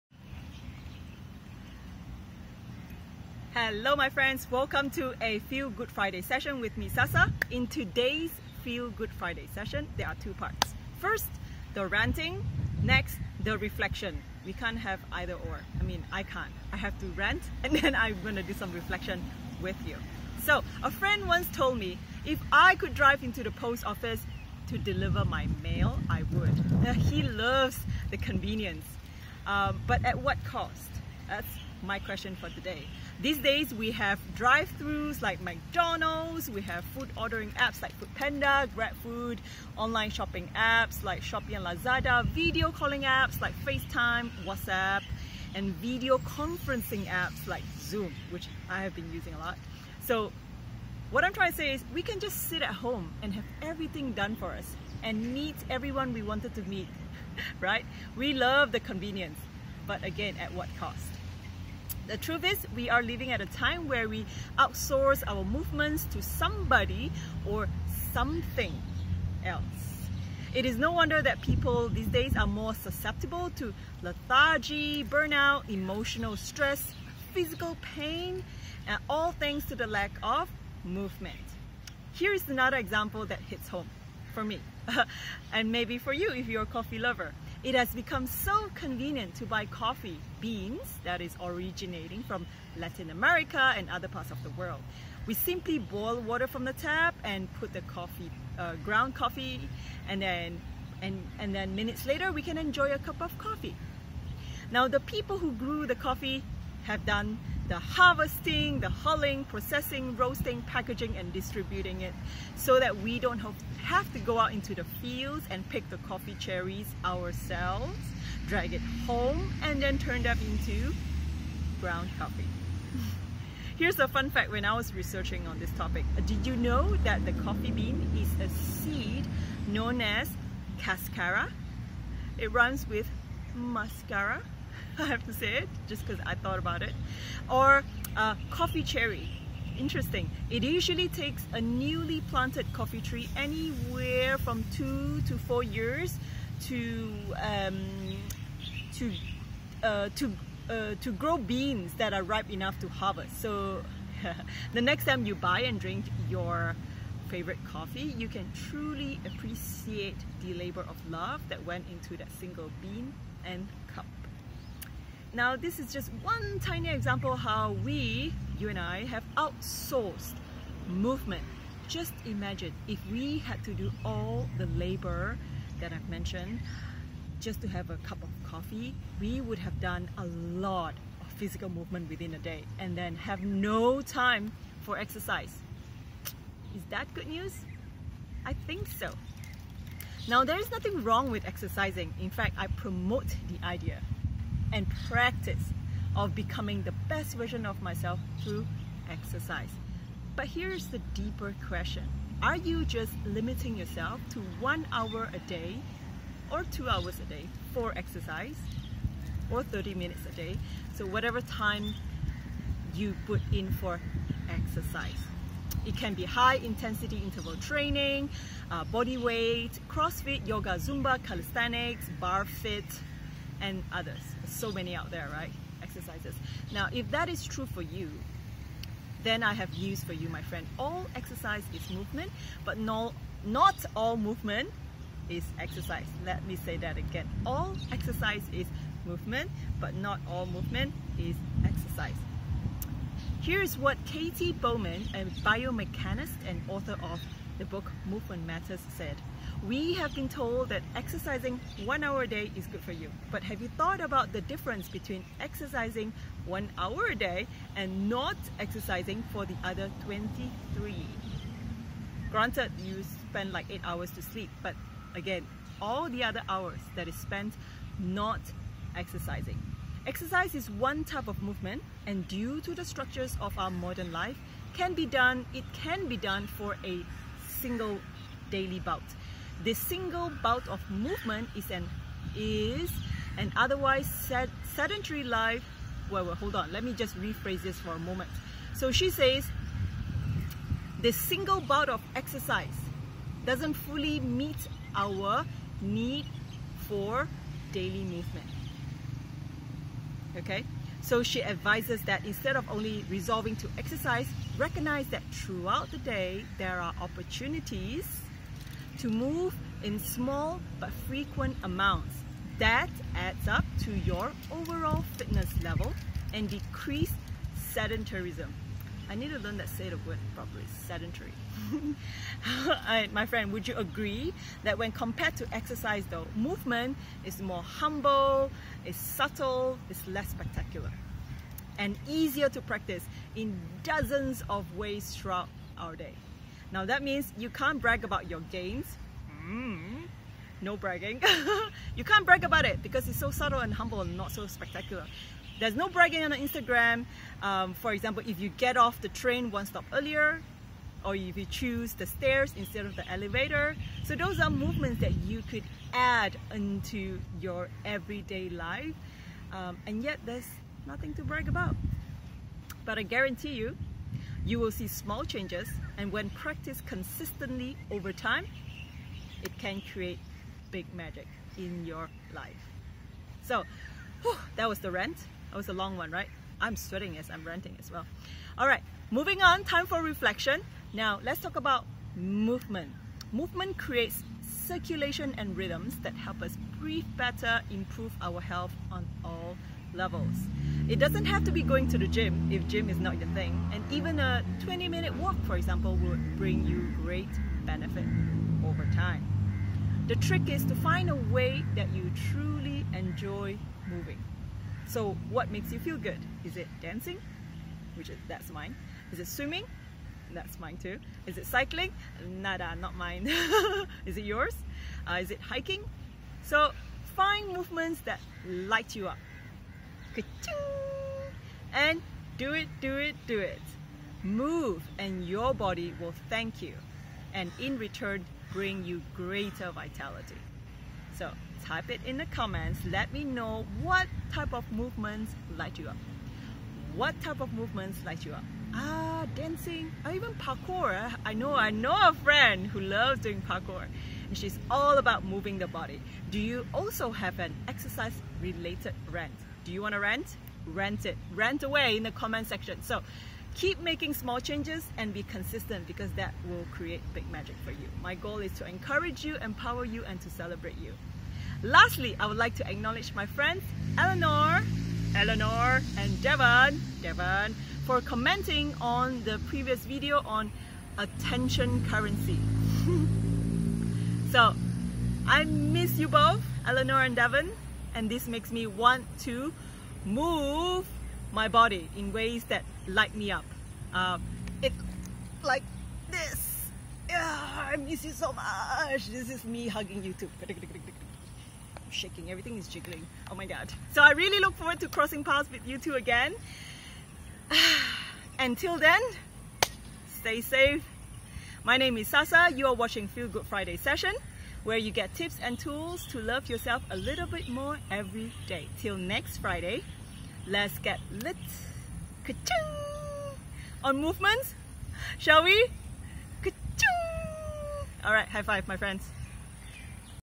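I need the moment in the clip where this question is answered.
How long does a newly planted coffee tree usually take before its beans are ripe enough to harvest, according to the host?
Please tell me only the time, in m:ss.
2:24.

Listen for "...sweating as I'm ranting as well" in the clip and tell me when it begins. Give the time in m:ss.
6:16.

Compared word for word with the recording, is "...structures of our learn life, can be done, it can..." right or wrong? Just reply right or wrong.
wrong.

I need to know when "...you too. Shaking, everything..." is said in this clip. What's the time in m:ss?
8:10.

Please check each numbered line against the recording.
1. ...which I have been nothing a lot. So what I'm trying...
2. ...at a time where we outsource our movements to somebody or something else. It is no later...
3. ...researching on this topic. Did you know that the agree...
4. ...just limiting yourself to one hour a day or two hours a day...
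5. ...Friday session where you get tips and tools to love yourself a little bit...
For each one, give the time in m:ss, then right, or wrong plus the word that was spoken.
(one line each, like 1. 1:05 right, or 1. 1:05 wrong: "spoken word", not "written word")
1. 0:48 wrong: "using", not "nothing"
2. 1:03 wrong: "wonder", not "later"
3. 2:04 wrong: "coffee", not "agree"
4. 3:22 right
5. 8:23 right.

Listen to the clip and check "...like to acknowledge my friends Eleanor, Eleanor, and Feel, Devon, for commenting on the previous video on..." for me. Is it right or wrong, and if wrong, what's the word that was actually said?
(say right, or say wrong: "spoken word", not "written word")
wrong: "Devon", not "Feel".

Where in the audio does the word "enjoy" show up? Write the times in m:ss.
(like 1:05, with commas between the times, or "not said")
1:42, 6:42.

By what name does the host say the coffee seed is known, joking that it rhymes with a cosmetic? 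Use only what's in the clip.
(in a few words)
cascara.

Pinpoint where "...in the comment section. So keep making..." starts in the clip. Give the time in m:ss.
7:31.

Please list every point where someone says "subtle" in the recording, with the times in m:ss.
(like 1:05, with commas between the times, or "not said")
5:28, 5:43.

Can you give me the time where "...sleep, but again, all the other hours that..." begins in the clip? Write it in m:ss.
4:24.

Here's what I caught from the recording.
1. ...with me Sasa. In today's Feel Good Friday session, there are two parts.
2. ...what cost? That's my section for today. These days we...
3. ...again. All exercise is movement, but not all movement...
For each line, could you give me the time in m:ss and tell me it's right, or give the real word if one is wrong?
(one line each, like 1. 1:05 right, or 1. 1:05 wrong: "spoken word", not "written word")
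1. 0:06 right
2. 0:30 wrong: "question", not "section"
3. 3:56 right.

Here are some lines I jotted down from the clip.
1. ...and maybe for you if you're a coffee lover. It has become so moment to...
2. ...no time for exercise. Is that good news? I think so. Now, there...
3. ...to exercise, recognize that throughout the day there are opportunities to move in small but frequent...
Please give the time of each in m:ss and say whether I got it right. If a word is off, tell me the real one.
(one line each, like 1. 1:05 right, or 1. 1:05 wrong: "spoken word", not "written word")
1. 1:25 wrong: "convenient", not "moment"
2. 3:03 right
3. 5:03 right.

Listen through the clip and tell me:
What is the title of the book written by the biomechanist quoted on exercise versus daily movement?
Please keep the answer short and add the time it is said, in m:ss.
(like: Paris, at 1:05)
Movement Matters, at 4:08.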